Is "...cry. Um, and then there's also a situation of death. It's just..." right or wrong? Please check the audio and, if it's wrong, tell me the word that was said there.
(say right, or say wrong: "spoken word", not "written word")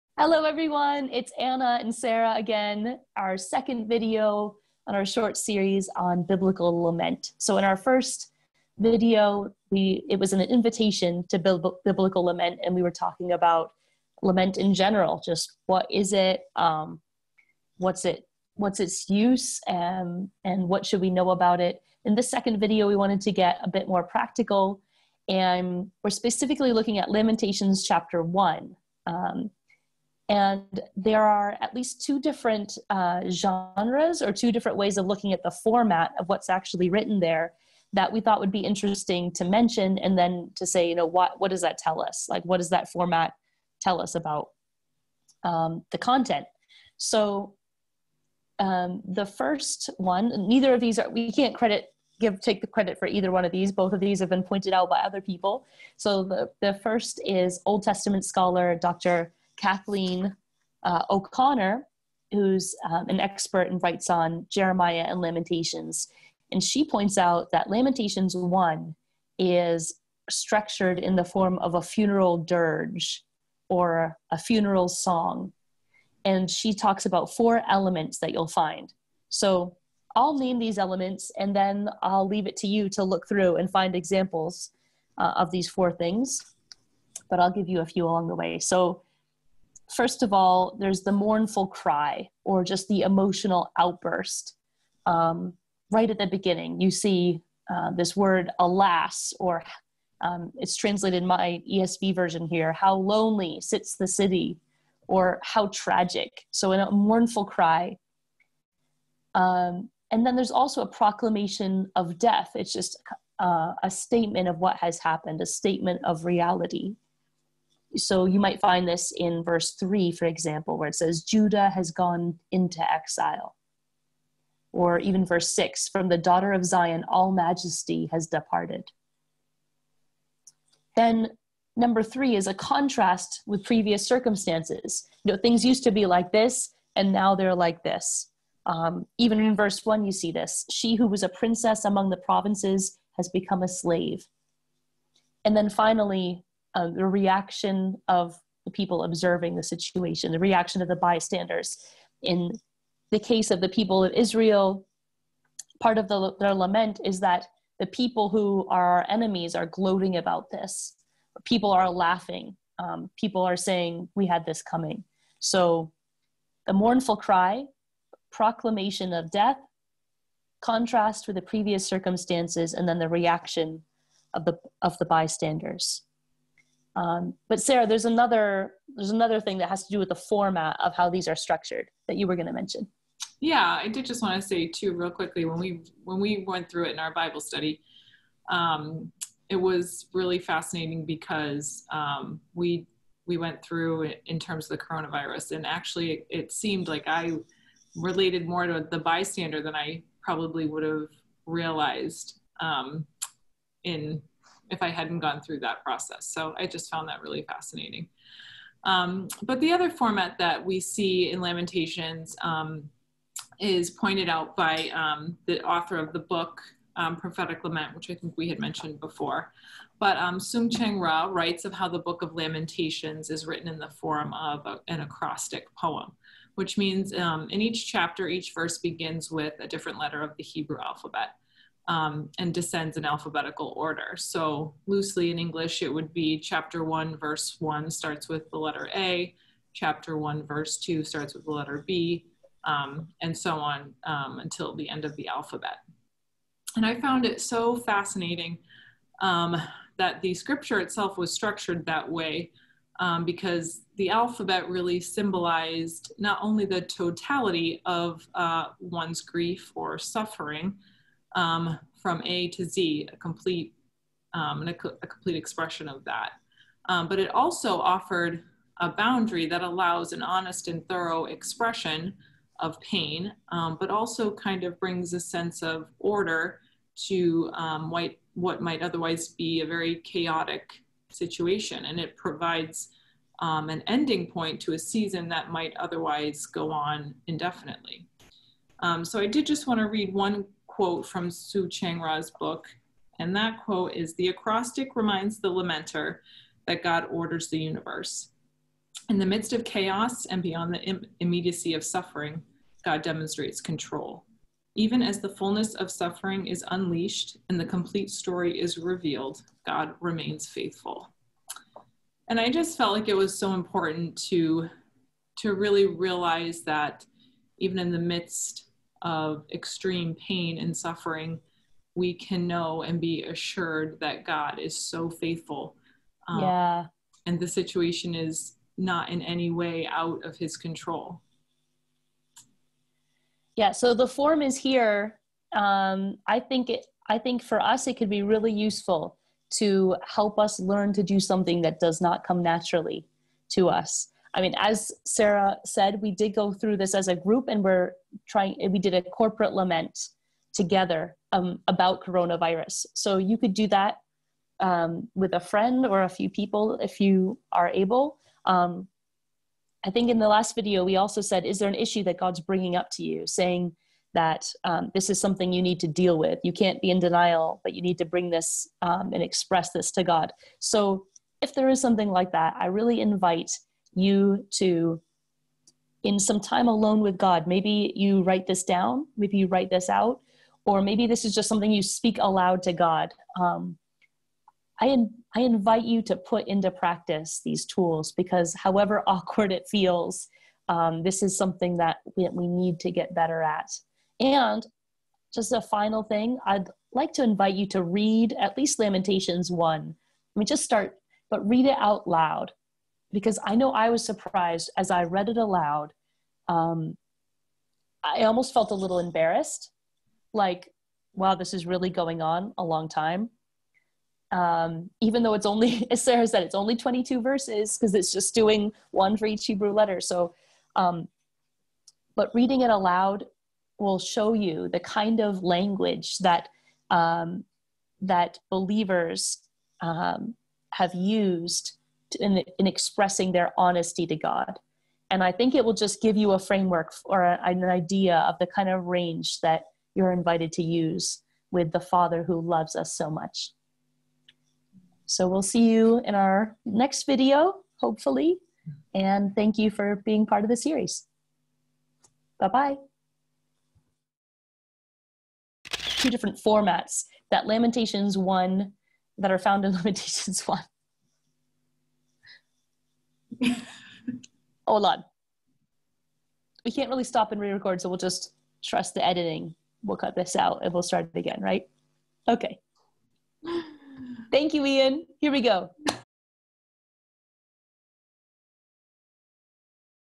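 wrong: "proclamation", not "situation".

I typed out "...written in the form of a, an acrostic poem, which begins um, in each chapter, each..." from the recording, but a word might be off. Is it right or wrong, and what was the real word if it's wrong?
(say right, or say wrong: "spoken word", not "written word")
wrong: "means", not "begins".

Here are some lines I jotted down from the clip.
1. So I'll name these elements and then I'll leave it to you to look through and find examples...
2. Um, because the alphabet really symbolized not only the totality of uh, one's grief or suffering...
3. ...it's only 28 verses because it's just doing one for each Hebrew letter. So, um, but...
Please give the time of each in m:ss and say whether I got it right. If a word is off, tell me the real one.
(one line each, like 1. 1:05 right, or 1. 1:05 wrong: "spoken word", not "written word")
1. 1:19 right
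2. 4:12 right
3. 6:56 wrong: "22", not "28".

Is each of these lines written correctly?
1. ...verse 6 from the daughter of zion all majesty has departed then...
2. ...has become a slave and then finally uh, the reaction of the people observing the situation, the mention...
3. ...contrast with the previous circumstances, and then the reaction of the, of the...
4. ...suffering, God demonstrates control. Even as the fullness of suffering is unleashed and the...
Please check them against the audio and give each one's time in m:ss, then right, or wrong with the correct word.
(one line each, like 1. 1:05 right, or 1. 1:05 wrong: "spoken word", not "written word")
1. 2:05 right
2. 2:23 wrong: "reaction", not "mention"
3. 2:50 right
4. 5:01 right.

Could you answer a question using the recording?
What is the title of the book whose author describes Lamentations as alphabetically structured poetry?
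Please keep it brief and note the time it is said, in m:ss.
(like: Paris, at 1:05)
Prophetic Lament, at 3:37.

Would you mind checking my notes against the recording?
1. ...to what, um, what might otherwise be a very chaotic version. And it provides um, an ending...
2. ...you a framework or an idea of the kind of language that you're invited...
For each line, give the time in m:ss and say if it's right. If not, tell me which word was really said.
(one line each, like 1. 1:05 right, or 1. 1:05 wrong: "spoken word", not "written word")
1. 4:37 wrong: "situation", not "version"
2. 7:16 wrong: "range", not "language".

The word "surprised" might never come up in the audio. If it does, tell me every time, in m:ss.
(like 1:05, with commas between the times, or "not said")
6:44.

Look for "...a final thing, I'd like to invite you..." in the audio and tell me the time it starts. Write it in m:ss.
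6:35.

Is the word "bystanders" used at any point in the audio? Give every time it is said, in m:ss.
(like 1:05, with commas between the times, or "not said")
2:30, 2:55, 3:18.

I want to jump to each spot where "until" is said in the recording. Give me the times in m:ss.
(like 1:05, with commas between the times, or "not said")
4:04.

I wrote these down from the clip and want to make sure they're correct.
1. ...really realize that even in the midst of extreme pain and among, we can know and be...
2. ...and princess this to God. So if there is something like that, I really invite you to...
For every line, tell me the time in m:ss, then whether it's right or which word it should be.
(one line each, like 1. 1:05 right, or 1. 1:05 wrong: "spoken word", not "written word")
1. 5:15 wrong: "suffering", not "among"
2. 6:09 wrong: "express", not "princess".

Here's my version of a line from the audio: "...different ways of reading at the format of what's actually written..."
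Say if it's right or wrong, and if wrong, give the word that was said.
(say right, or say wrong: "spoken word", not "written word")
wrong: "looking", not "reading".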